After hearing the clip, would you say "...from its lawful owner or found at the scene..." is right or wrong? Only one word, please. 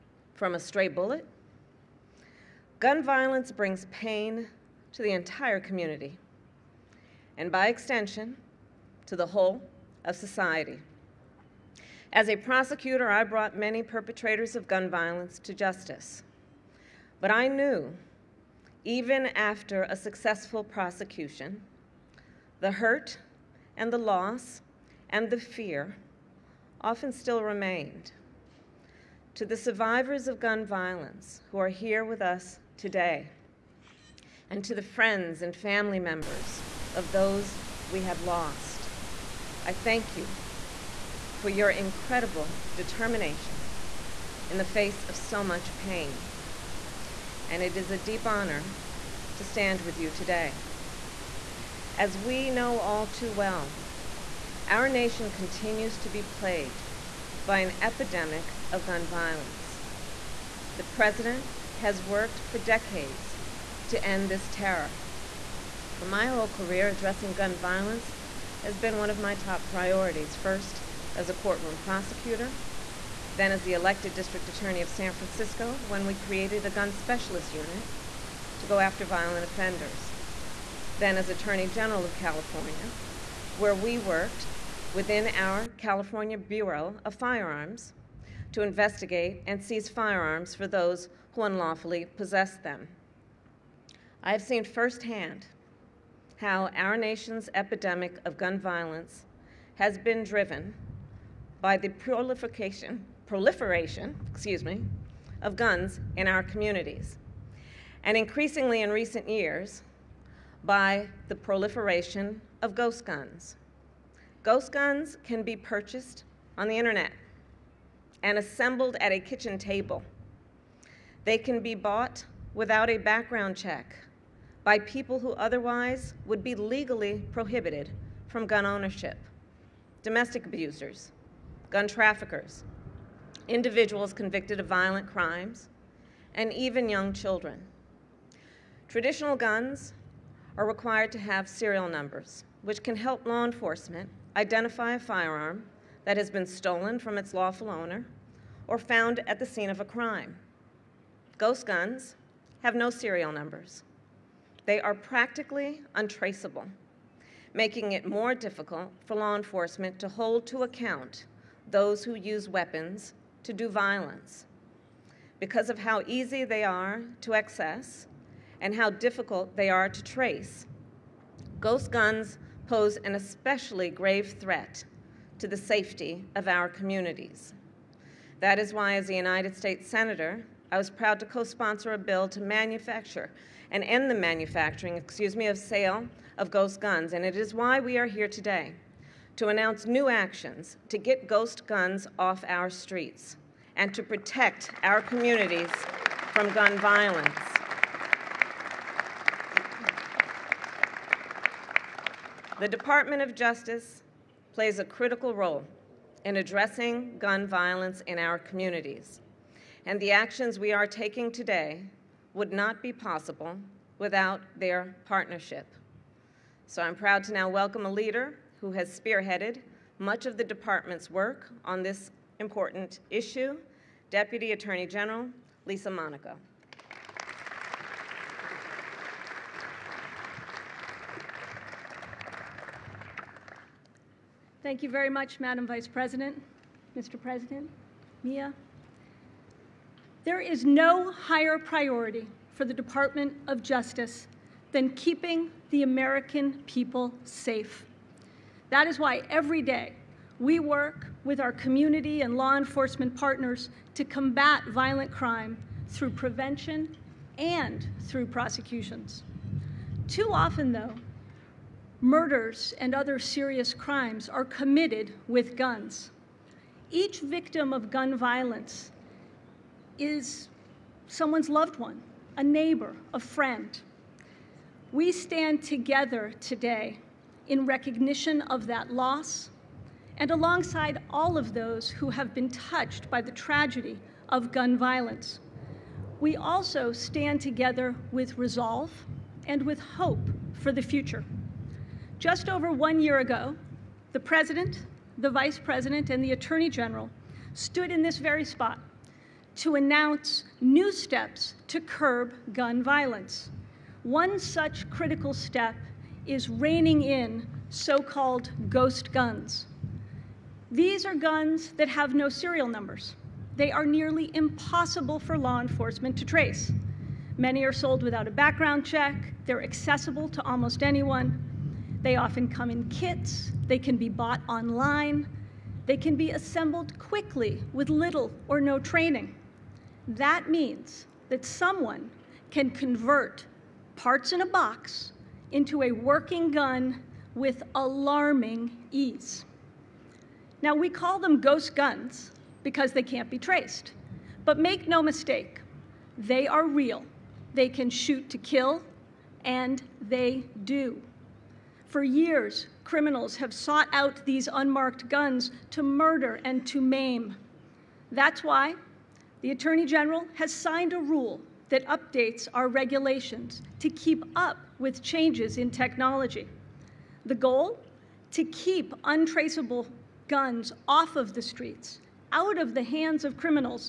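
right.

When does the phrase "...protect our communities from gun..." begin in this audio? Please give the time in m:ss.
3:14.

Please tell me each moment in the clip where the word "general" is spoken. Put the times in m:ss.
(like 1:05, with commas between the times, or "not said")
1:21, 3:44, 4:56, 5:59.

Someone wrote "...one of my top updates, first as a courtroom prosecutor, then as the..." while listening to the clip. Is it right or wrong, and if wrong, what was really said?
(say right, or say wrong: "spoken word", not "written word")
wrong: "priorities", not "updates".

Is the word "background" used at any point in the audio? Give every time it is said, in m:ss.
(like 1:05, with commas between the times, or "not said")
2:02, 5:18.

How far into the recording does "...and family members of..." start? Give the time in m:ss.
0:35.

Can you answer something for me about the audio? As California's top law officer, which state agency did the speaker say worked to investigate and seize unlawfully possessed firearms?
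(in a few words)
California Bureau of Firearms.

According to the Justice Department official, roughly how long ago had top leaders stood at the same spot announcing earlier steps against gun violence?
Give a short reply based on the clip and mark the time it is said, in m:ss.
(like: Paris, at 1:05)
Just over one year, at 4:52.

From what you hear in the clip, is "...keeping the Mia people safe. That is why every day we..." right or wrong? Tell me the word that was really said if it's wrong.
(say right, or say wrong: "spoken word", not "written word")
wrong: "American", not "Mia".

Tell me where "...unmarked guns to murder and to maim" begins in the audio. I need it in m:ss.
5:54.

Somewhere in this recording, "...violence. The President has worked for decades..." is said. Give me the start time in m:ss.
0:59.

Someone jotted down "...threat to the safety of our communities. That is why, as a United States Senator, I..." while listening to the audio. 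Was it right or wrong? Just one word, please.
right.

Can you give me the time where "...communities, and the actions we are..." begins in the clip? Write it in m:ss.
3:28.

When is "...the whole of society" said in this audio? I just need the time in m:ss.
0:09.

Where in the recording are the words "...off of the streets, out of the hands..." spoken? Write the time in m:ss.
6:10.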